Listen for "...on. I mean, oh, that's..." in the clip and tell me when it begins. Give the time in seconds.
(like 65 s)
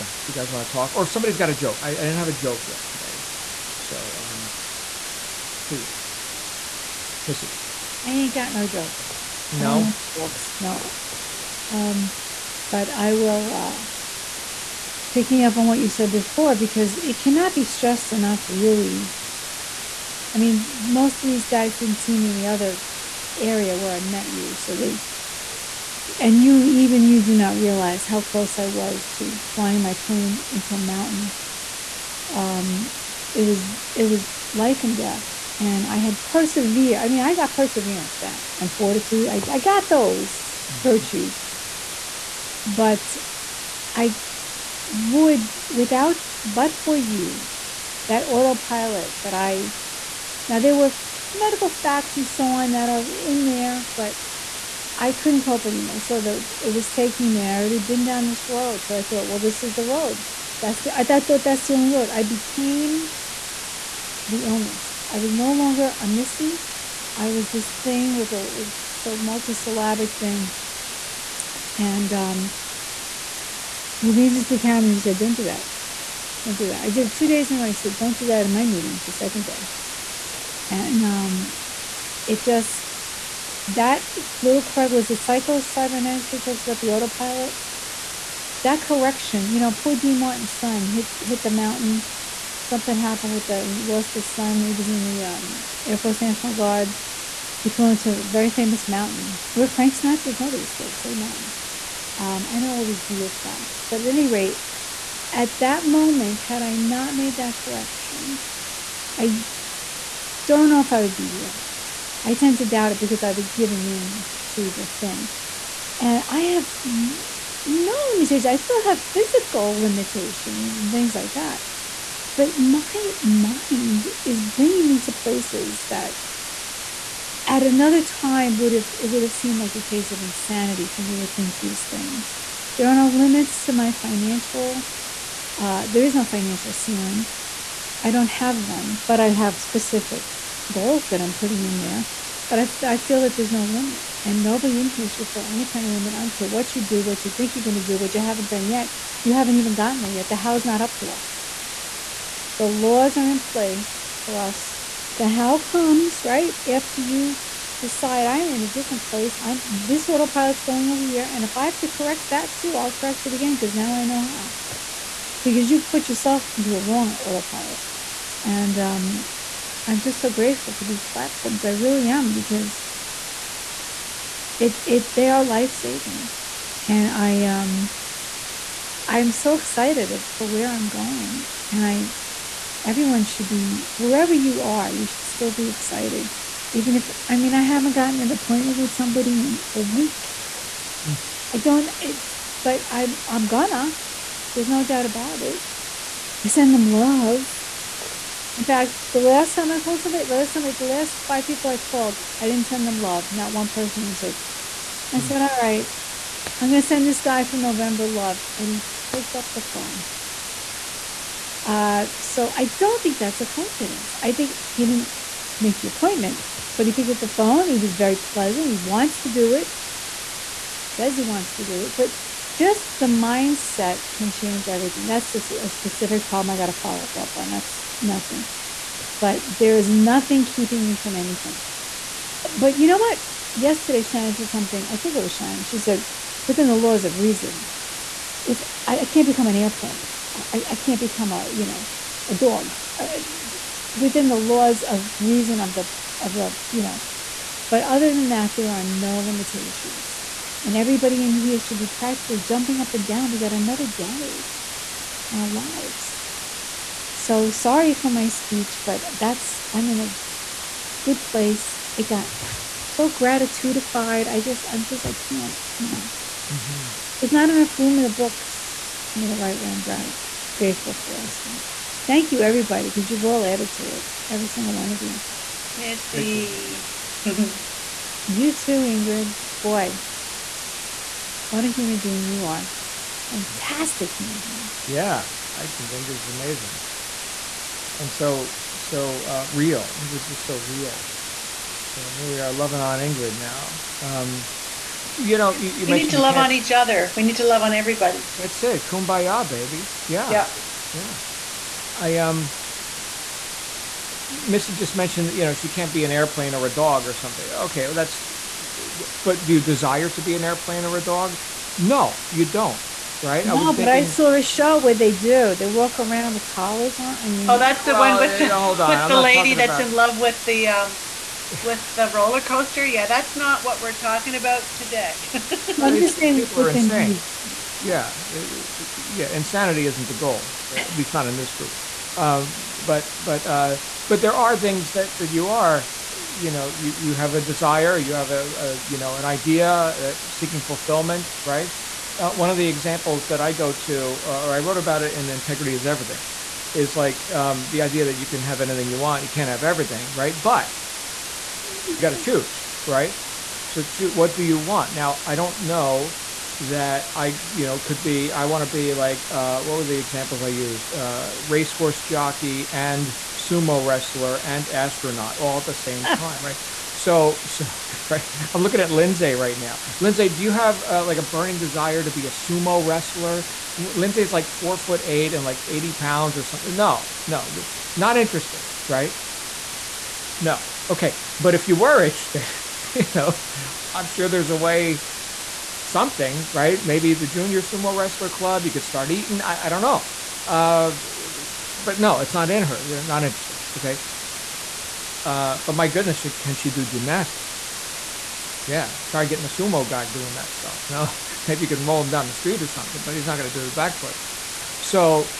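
317 s.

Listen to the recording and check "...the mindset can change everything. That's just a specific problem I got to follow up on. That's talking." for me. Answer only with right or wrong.
wrong.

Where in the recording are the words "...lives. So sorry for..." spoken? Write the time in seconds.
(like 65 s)
255 s.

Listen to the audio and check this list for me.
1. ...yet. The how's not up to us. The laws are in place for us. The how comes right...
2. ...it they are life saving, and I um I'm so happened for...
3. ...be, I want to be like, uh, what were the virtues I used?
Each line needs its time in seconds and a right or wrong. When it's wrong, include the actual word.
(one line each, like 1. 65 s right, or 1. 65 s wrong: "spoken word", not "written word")
1. 150 s right
2. 174 s wrong: "excited", not "happened"
3. 358 s wrong: "examples", not "virtues".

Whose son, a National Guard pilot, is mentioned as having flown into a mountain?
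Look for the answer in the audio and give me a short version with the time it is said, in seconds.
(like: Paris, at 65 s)
Dean Martin, at 89 s.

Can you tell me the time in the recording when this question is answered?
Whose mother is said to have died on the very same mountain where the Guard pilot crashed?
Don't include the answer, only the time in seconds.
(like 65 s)
99 s.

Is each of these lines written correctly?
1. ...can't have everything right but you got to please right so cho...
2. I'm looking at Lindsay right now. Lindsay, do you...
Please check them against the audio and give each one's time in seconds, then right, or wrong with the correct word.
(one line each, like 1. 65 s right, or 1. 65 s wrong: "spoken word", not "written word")
1. 349 s wrong: "choose", not "please"
2. 368 s right.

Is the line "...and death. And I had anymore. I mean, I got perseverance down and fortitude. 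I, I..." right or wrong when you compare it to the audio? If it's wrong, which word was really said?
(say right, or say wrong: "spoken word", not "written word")
wrong: "persevere", not "anymore".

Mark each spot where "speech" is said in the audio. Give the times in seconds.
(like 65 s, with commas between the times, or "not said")
258 s.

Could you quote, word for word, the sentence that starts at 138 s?
I don't have one, but I have specific goals that I'm putting in there.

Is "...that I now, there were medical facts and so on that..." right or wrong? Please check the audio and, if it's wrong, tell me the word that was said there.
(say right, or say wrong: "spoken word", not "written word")
right.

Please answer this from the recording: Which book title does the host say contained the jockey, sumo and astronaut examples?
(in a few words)
Integrity is Everything.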